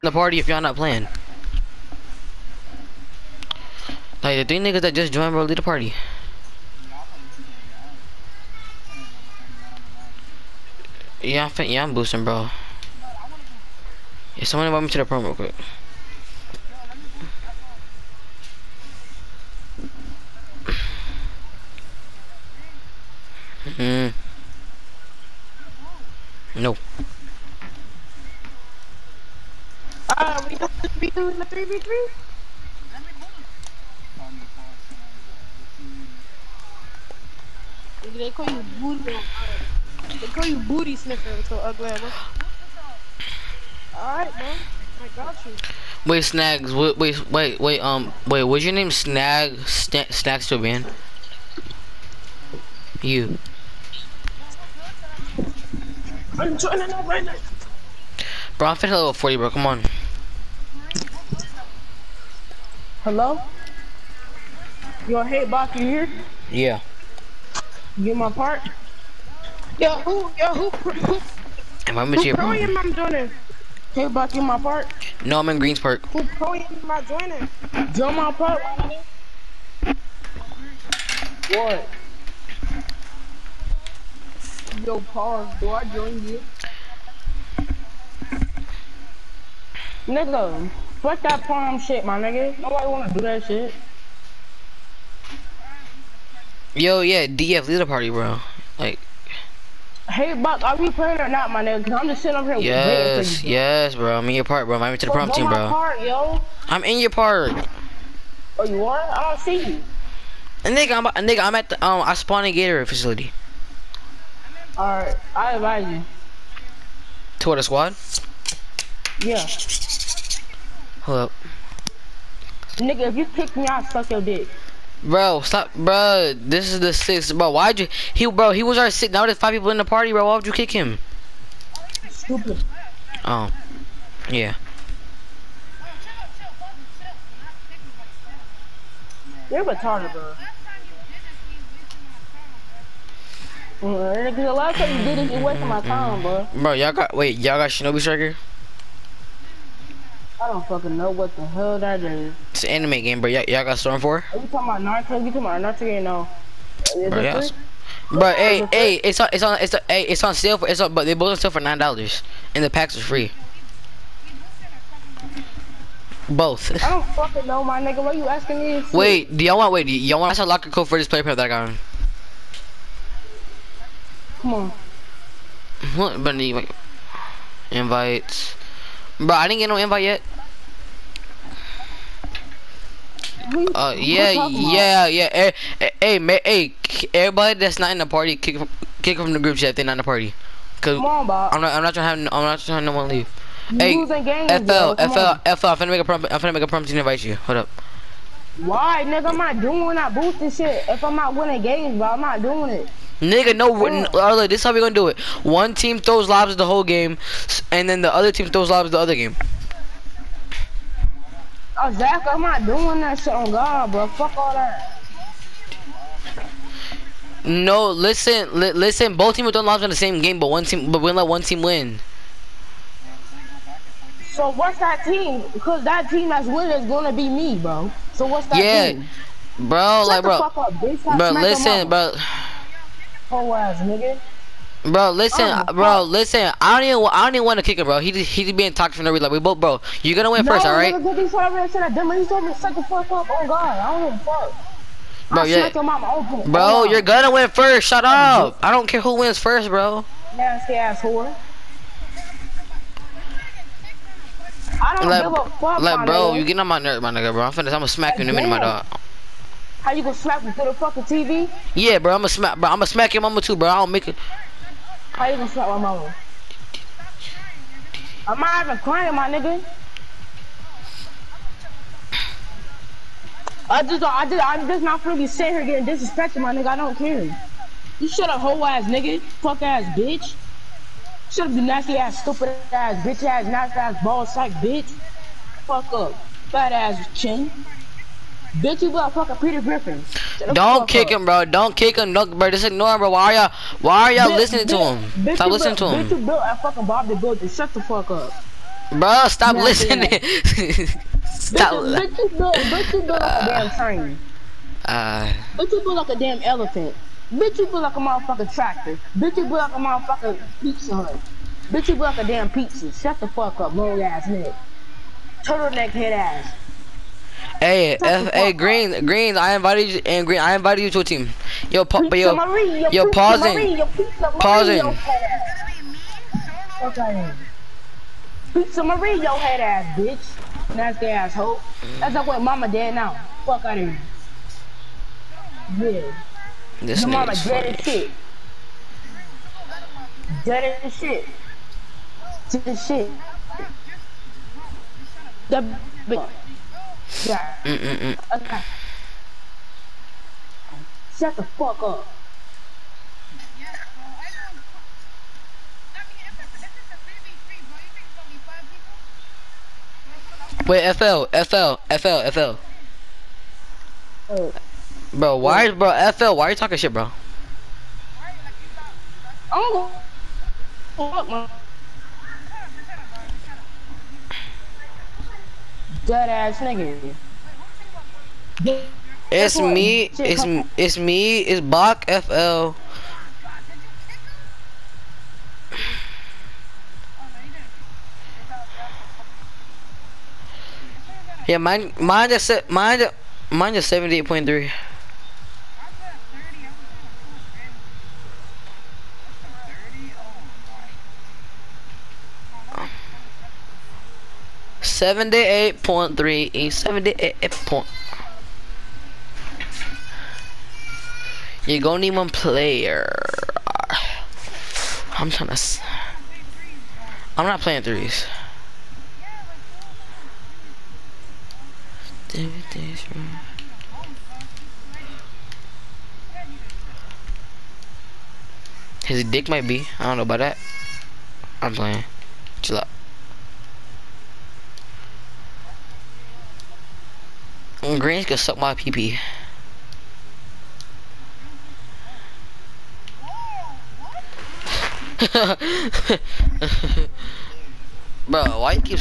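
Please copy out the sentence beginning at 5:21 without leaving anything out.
Yo, pa but yo, Maria, yo, pausing, Maria, pausing.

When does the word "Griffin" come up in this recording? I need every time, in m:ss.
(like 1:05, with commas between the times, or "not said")
4:49.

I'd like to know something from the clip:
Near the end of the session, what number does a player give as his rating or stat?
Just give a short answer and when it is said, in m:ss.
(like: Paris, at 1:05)
78.3, at 6:33.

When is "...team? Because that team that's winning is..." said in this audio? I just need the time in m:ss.
3:45.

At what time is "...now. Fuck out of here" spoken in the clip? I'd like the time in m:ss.
5:32.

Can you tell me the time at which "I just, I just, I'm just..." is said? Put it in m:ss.
4:33.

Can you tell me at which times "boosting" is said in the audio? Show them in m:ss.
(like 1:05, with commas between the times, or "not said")
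0:11, 3:20.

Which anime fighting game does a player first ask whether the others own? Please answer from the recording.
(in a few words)
Shinobi Striker.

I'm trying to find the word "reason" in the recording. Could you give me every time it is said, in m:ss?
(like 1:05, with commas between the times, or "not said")
3:59.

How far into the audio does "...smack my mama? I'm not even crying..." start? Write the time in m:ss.
4:25.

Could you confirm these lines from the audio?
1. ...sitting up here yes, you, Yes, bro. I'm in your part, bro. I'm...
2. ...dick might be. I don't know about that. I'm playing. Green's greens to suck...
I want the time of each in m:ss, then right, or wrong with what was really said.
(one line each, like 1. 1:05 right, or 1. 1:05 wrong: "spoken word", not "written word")
1. 1:42 right
2. 7:09 right.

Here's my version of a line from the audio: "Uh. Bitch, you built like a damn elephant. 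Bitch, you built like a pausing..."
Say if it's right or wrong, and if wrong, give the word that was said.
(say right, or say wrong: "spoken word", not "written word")
wrong: "motherfucking", not "pausing".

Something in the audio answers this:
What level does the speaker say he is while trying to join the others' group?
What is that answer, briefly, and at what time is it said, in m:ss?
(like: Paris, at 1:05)
40, at 0:58.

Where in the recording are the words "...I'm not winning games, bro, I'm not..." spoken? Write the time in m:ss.
3:21.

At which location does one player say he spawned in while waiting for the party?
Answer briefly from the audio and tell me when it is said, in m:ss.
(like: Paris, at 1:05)
Gator facility, at 1:52.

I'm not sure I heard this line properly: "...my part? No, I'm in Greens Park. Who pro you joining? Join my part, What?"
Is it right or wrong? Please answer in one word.
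right.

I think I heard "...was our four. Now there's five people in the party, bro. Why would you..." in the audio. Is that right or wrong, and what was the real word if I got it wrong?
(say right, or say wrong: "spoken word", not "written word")
wrong: "six", not "four".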